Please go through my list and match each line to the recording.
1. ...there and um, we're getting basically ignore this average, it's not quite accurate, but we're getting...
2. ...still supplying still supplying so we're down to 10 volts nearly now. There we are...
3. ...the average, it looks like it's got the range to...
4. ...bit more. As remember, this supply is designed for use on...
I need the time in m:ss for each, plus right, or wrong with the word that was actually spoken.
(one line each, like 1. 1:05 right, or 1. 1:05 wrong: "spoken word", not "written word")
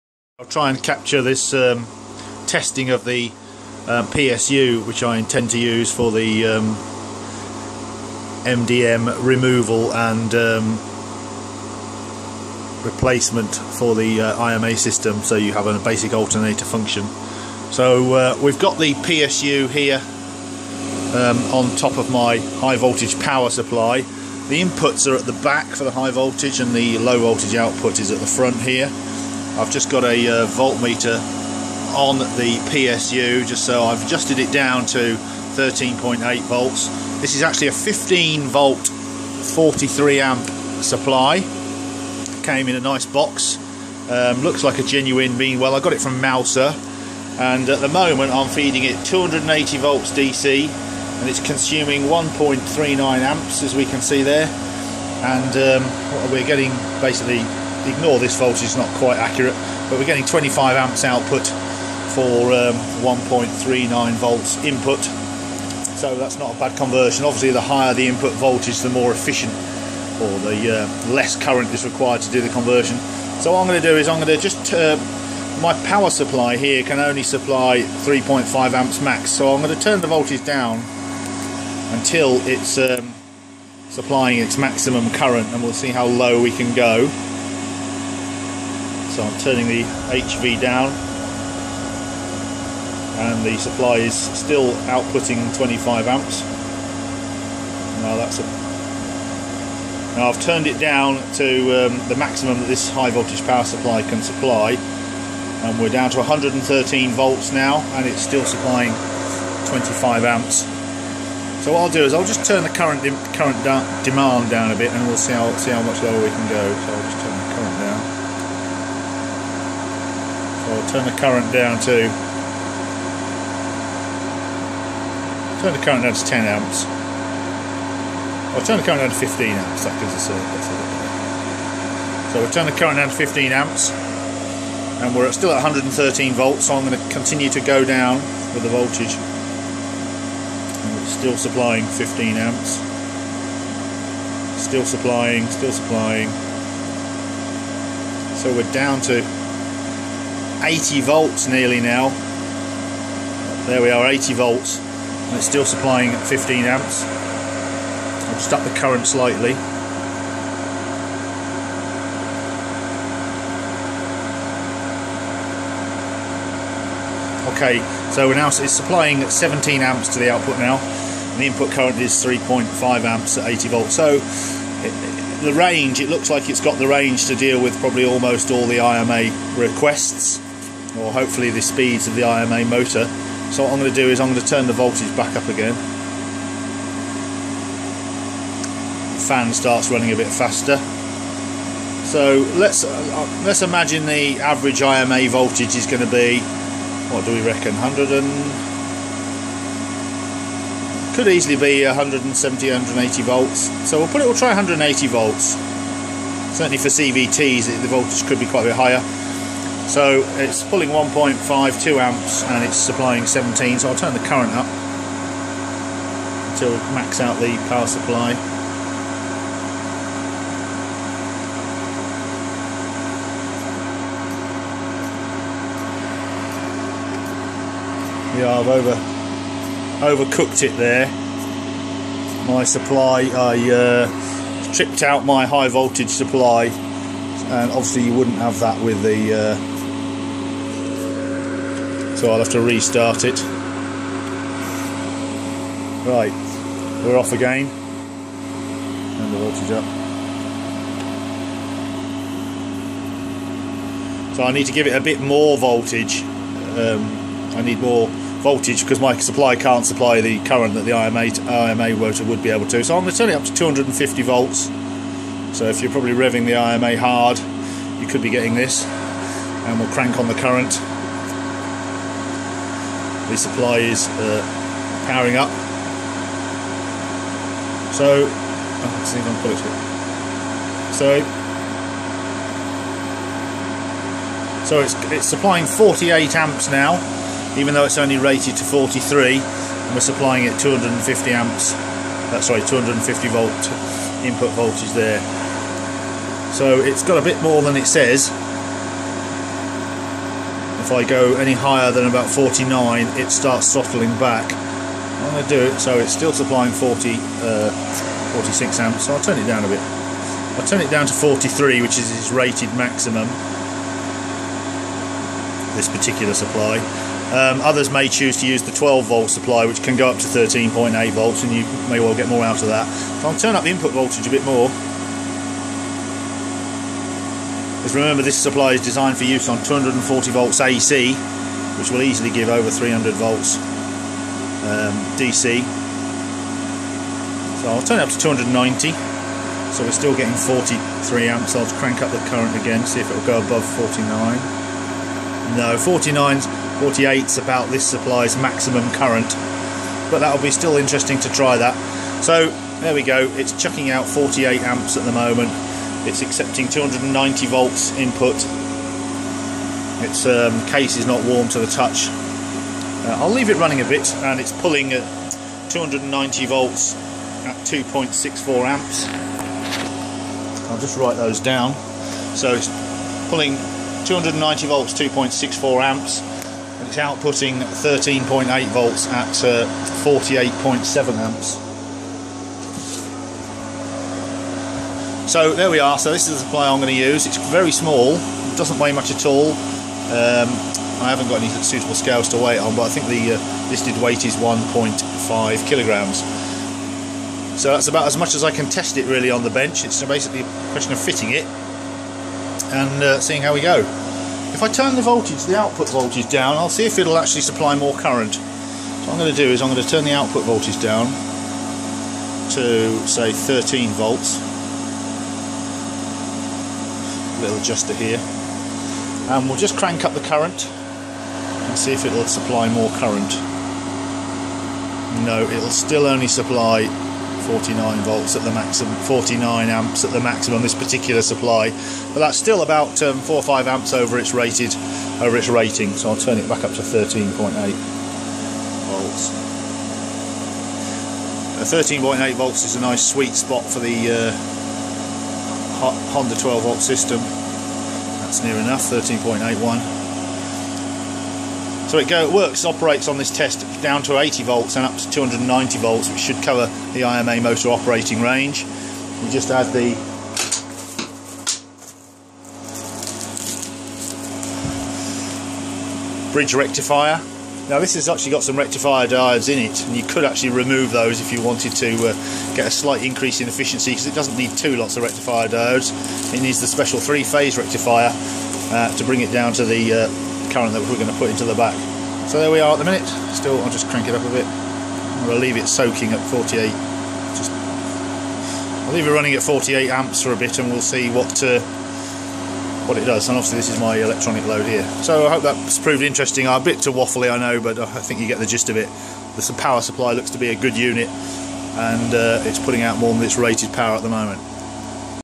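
1. 0:54 wrong: "voltage", not "average"
2. 2:24 wrong: "80", not "10"
3. 2:55 wrong: "range", not "average"
4. 5:24 right.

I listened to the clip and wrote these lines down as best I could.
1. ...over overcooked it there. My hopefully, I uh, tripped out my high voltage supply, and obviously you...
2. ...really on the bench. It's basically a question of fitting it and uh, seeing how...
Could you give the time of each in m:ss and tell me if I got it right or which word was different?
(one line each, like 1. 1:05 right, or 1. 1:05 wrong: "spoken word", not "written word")
1. 3:48 wrong: "supply", not "hopefully"
2. 6:39 right.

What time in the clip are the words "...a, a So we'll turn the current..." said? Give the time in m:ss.
2:10.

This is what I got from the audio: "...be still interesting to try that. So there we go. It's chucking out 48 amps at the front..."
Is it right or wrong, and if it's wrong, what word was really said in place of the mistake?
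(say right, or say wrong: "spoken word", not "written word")
wrong: "moment", not "front".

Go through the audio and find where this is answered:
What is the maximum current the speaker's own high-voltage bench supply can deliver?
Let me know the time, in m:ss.
1:17.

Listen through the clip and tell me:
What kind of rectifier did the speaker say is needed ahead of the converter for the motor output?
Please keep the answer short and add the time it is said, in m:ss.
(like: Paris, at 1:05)
three phase rectifier, at 7:56.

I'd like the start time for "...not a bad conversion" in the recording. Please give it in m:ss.
1:06.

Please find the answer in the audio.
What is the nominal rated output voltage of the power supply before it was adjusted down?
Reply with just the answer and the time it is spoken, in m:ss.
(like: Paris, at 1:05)
15 volts, at 0:37.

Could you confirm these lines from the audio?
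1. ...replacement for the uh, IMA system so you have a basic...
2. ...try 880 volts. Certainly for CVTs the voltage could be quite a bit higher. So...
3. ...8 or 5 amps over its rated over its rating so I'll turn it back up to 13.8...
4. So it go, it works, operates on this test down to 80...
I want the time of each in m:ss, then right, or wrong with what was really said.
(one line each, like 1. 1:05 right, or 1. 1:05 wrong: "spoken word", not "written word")
1. 0:12 right
2. 3:24 wrong: "180", not "880"
3. 7:13 wrong: "4", not "8"
4. 7:31 right.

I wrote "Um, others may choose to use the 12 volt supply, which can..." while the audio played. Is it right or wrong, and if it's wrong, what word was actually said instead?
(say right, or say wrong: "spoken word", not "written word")
right.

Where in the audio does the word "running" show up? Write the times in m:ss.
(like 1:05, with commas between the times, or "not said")
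3:09, 6:03, 8:09.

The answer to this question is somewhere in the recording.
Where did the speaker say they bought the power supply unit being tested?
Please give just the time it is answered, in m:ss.
0:46.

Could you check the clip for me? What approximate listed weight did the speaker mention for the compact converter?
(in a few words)
1.5 kilograms.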